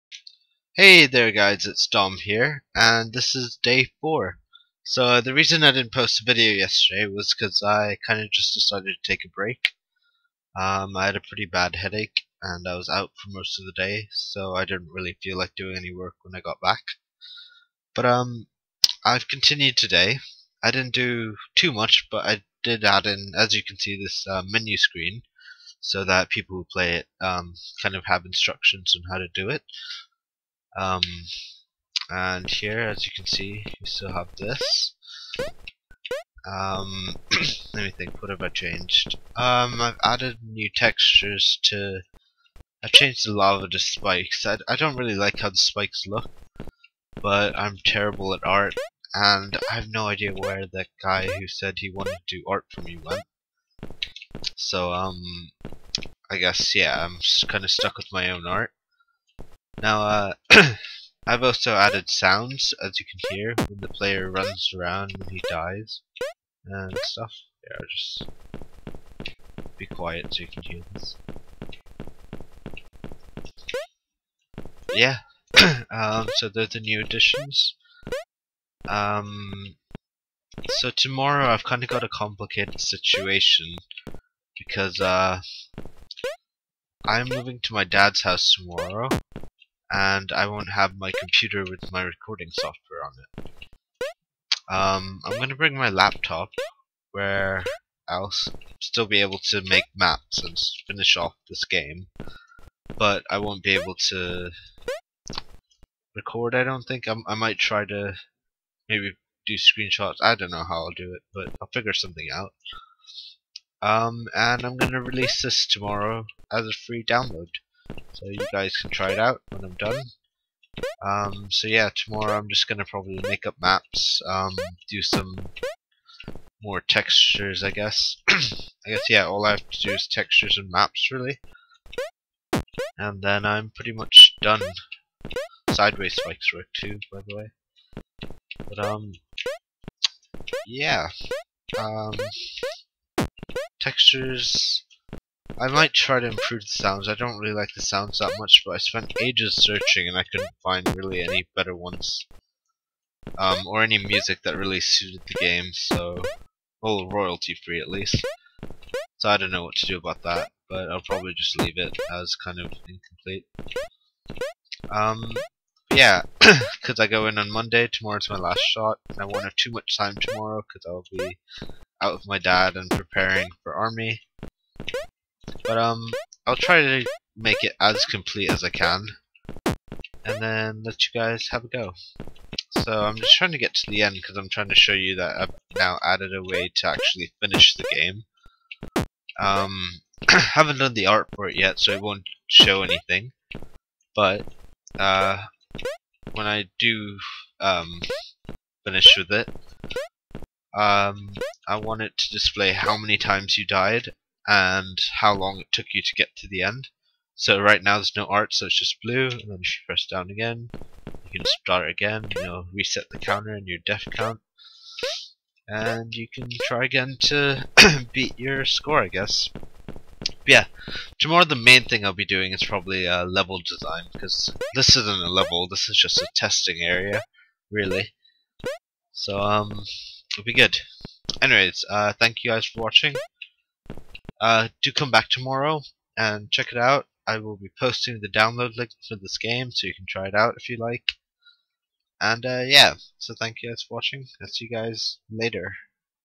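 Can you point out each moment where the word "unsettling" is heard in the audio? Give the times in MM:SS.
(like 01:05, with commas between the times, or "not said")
not said.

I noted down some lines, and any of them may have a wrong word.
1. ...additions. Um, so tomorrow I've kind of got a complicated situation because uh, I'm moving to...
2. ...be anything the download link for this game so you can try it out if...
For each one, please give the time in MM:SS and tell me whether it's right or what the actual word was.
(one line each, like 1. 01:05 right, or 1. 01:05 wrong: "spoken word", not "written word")
1. 01:17 right
2. 03:57 wrong: "posting", not "anything".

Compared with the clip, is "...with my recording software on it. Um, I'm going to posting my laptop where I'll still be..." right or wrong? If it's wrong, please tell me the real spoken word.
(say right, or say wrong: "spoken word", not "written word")
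wrong: "bring", not "posting".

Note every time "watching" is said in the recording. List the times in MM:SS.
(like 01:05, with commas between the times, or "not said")
03:52, 04:03.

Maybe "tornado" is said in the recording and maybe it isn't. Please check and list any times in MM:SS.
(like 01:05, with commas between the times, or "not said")
not said.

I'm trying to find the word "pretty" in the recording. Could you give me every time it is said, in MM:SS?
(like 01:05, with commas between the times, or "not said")
00:11, 02:13.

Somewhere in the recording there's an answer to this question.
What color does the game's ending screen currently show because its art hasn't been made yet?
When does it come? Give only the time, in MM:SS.
03:29.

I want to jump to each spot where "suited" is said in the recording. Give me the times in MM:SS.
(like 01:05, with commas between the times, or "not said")
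02:34.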